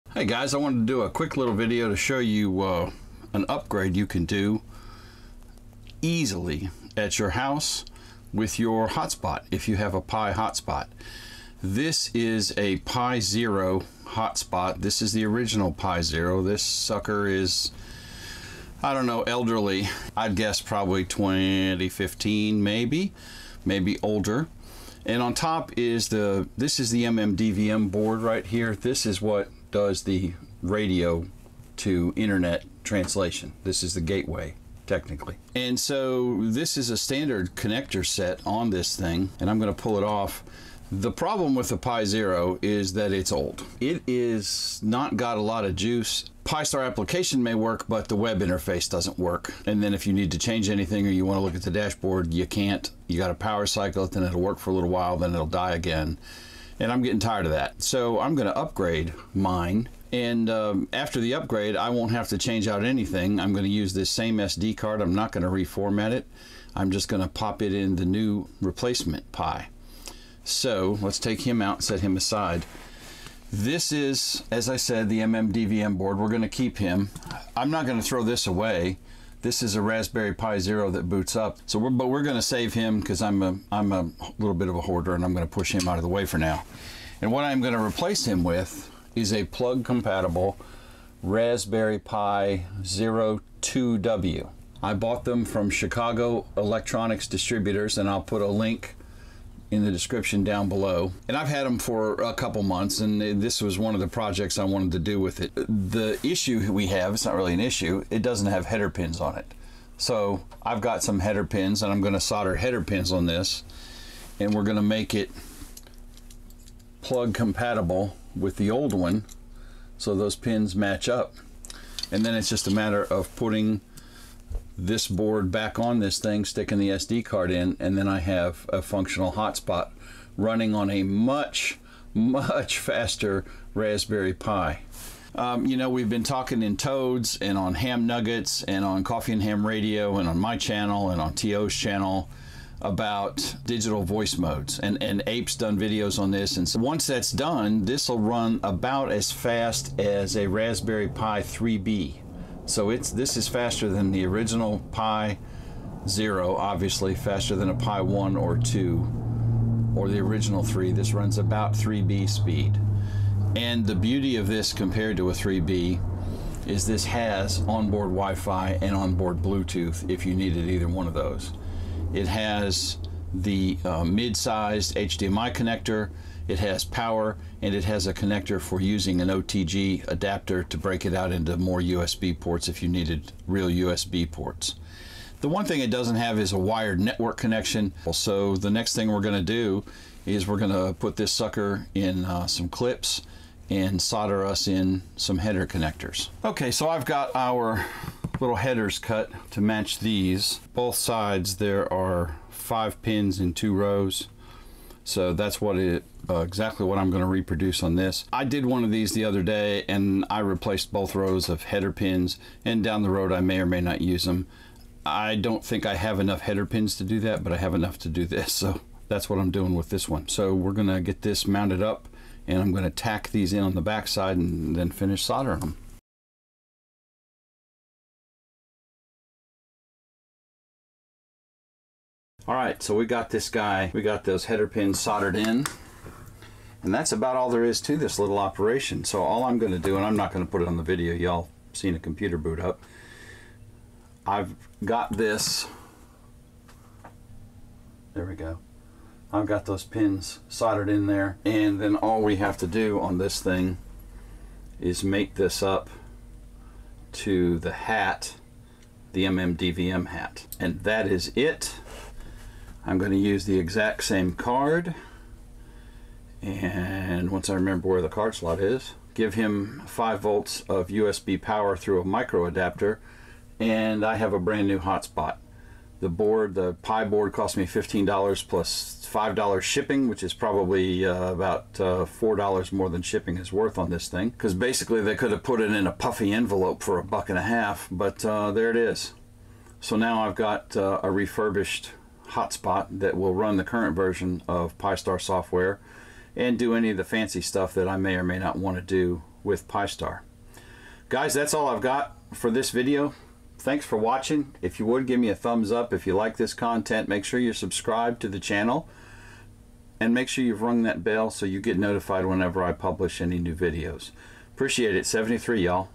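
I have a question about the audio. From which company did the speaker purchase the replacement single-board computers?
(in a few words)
Chicago Electronics Distributors.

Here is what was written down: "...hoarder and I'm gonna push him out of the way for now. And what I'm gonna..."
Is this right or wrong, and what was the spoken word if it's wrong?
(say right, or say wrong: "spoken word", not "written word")
right.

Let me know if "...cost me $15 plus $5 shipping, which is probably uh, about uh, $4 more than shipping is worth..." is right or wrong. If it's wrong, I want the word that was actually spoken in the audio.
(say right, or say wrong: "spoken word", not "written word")
right.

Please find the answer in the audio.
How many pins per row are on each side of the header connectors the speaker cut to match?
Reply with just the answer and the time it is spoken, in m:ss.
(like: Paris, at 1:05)
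5, at 3:22.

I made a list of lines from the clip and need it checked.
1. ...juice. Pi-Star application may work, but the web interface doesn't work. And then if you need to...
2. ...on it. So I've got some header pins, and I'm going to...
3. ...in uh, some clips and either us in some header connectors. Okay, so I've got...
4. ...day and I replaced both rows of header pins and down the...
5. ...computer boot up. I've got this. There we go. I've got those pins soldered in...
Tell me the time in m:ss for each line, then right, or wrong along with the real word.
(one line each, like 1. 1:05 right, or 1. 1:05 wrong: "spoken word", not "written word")
1. 0:45 right
2. 1:49 right
3. 3:11 wrong: "solder", not "either"
4. 3:29 right
5. 4:01 right.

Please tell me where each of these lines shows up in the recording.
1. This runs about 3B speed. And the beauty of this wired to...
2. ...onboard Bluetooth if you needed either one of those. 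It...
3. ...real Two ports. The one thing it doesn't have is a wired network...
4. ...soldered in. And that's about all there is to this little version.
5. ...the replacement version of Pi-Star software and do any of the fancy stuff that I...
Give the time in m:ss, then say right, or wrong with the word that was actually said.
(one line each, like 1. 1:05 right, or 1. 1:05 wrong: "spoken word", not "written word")
1. 2:40 wrong: "compared", not "wired"
2. 2:48 right
3. 3:03 wrong: "USB", not "Two"
4. 3:54 wrong: "operation", not "version"
5. 4:53 wrong: "current", not "replacement".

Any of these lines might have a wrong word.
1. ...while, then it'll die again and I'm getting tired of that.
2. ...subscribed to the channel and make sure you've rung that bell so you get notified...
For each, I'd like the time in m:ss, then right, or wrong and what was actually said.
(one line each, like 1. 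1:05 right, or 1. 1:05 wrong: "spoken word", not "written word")
1. 0:54 right
2. 5:07 right.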